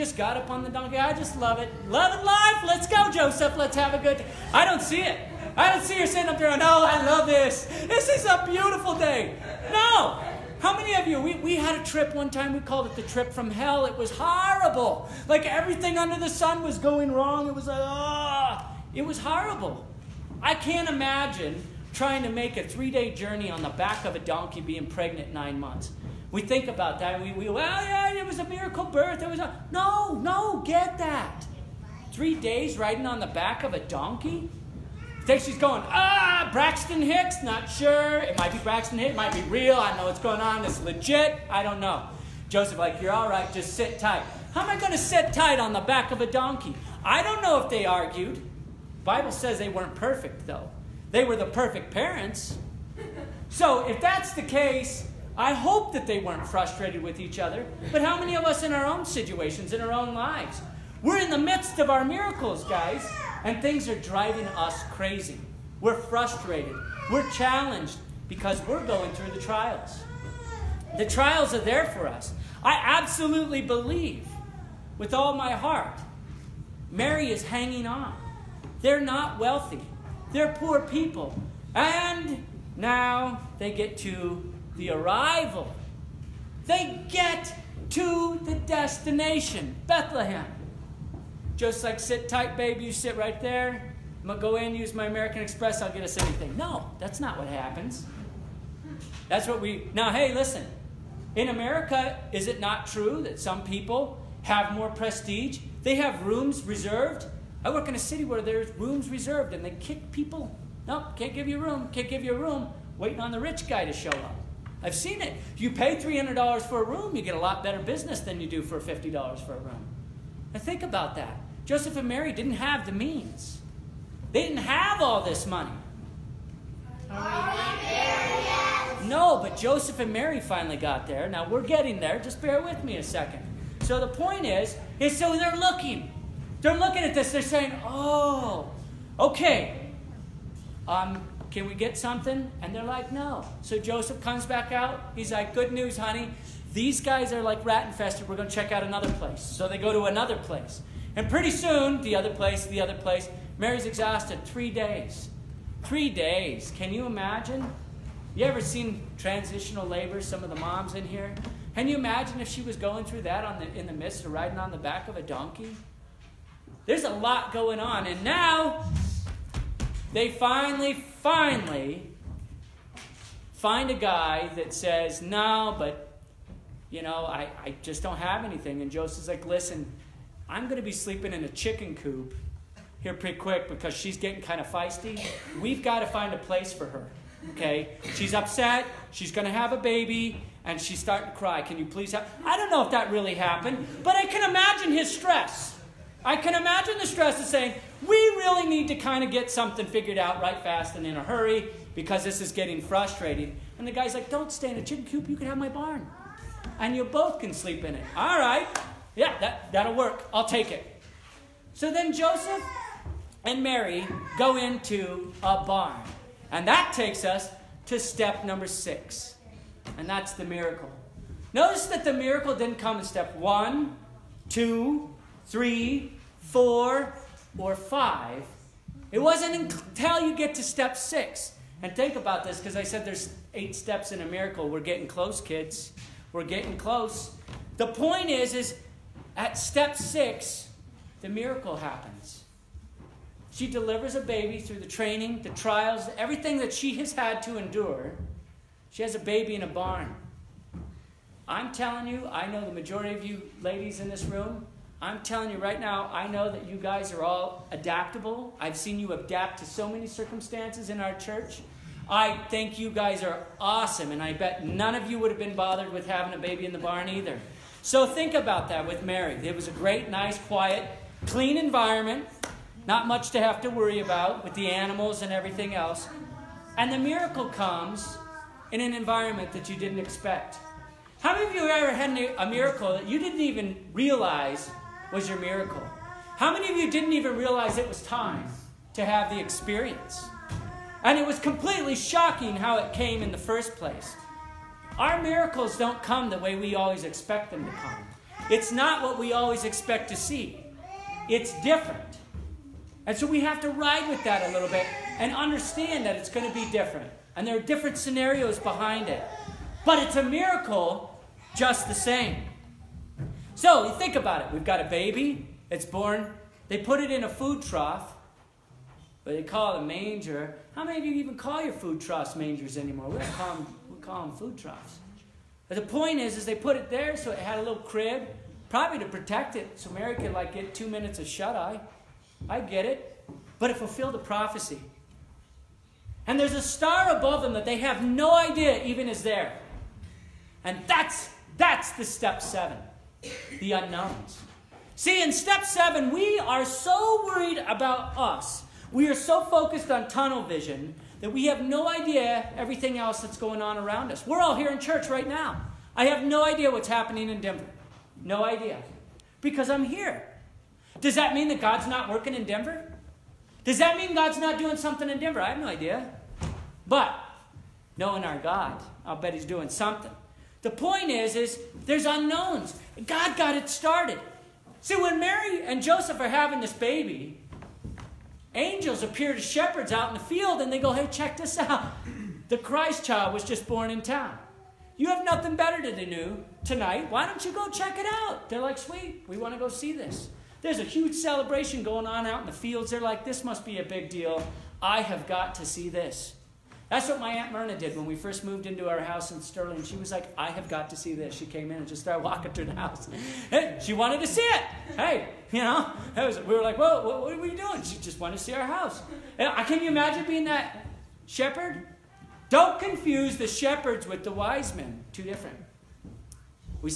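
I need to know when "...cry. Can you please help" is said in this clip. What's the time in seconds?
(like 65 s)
191 s.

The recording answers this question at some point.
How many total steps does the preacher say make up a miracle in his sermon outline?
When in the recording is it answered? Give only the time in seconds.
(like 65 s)
233 s.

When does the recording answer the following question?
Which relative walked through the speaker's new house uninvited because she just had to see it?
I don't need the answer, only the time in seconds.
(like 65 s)
397 s.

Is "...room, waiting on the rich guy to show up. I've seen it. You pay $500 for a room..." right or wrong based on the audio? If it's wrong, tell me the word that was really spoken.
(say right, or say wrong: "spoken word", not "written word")
wrong: "300", not "500".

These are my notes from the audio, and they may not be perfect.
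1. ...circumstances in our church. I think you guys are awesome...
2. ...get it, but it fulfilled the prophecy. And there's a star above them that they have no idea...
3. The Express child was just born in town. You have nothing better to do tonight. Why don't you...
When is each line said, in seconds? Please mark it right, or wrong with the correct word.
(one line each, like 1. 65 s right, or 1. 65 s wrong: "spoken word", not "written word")
1. 260 s right
2. 332 s right
3. 382 s wrong: "Christ", not "Express".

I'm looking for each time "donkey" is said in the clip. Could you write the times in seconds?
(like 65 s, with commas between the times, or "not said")
0 s, 24 s, 33 s, 46 s, 165 s.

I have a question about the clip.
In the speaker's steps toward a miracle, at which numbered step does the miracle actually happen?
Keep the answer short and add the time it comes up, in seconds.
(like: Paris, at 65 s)
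6, at 218 s.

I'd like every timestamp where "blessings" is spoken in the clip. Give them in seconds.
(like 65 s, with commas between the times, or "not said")
not said.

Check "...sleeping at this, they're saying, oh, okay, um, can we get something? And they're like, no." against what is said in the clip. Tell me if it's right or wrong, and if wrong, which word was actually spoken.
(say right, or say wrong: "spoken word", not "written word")
wrong: "looking", not "sleeping".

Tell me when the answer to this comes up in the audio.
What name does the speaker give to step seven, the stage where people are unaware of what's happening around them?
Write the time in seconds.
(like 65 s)
343 s.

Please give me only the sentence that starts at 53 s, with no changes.
So if that's the case, I hope that they weren't frustrated with each other.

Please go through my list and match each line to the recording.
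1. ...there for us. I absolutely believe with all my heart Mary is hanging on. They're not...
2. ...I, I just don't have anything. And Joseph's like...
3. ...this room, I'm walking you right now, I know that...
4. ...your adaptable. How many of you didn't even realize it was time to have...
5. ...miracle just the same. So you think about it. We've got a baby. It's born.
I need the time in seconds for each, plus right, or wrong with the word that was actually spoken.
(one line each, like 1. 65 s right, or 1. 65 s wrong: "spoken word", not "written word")
1. 71 s right
2. 177 s right
3. 254 s wrong: "telling", not "walking"
4. 285 s wrong: "miracle", not "adaptable"
5. 310 s right.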